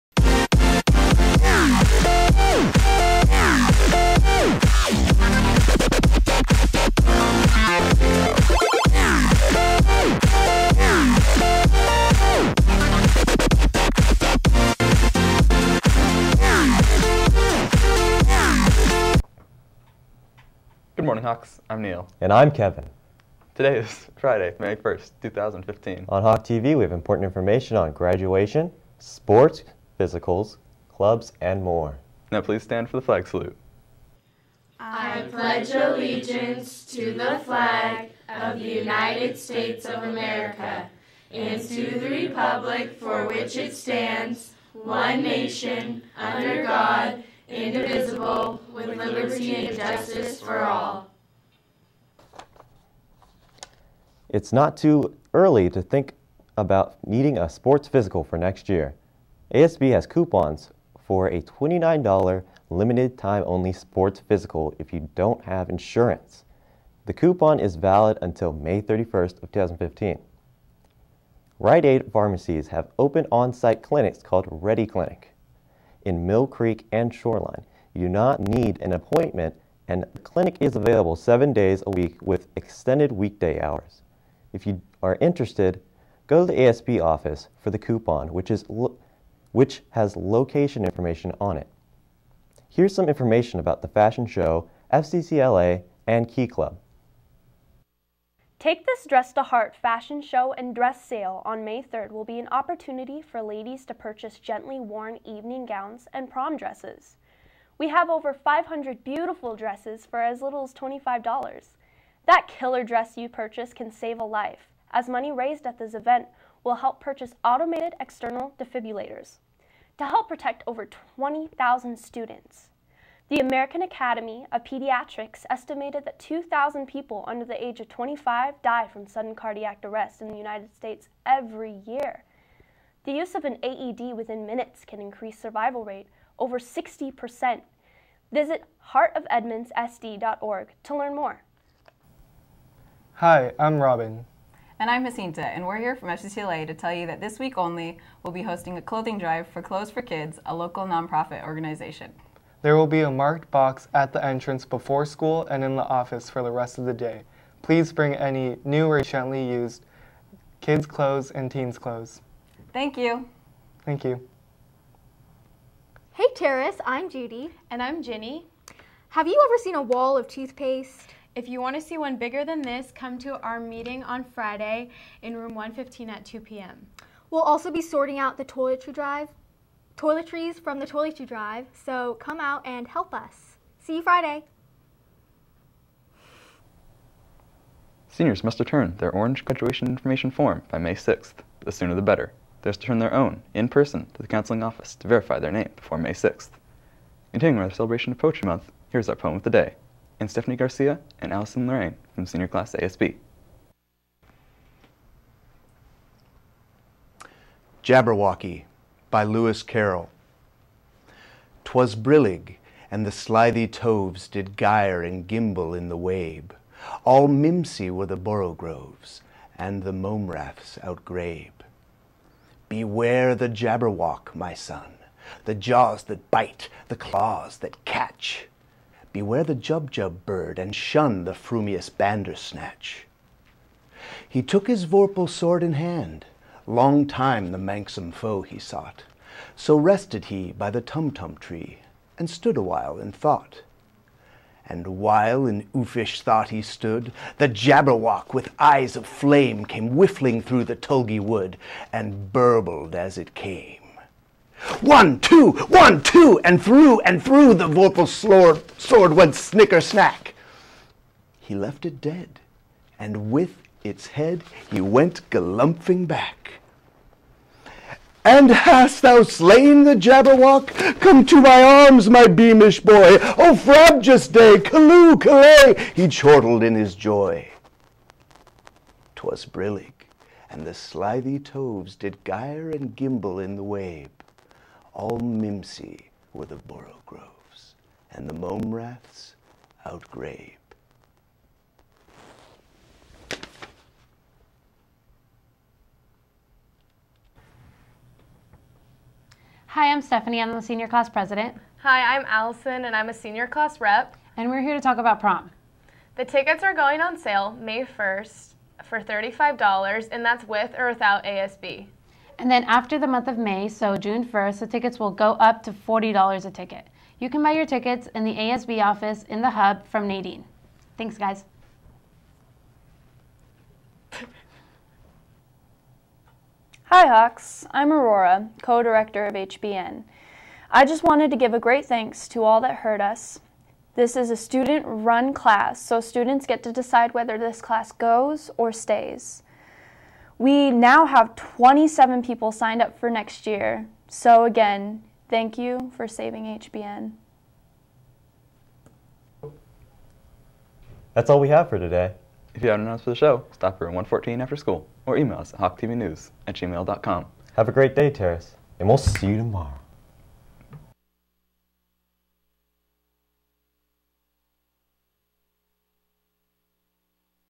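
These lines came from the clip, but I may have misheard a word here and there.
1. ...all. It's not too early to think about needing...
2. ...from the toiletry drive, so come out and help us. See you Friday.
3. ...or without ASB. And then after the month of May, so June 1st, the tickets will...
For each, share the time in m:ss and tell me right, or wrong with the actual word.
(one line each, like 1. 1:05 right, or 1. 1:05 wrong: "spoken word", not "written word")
1. 0:50 right
2. 3:00 right
3. 5:10 right.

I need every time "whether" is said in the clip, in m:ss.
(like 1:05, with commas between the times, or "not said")
5:37.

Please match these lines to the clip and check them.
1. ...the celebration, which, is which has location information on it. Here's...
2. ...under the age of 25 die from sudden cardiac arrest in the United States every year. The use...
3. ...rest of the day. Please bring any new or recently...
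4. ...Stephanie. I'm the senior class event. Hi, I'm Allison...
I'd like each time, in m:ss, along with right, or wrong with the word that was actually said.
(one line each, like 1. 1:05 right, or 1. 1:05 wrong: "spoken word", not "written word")
1. 1:27 wrong: "coupon", not "celebration"
2. 2:07 right
3. 2:36 right
4. 5:00 wrong: "president", not "event".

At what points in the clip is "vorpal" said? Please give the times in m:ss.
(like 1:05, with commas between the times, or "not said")
3:54, 4:17.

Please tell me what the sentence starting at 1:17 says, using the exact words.
You do not need an appointment and the clinic is available seven days a week with extended weekday hours.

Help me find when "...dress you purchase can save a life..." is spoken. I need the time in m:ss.
1:52.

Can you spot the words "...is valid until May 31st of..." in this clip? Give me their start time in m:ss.
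1:07.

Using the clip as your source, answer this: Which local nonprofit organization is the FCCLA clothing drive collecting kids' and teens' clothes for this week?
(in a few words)
Clothes for Kids.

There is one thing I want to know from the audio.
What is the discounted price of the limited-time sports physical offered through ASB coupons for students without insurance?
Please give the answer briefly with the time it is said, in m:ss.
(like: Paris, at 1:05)
$29, at 1:01.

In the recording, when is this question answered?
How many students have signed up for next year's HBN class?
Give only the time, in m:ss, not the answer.
5:41.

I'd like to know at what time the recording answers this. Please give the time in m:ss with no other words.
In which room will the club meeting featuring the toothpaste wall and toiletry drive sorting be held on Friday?
2:55.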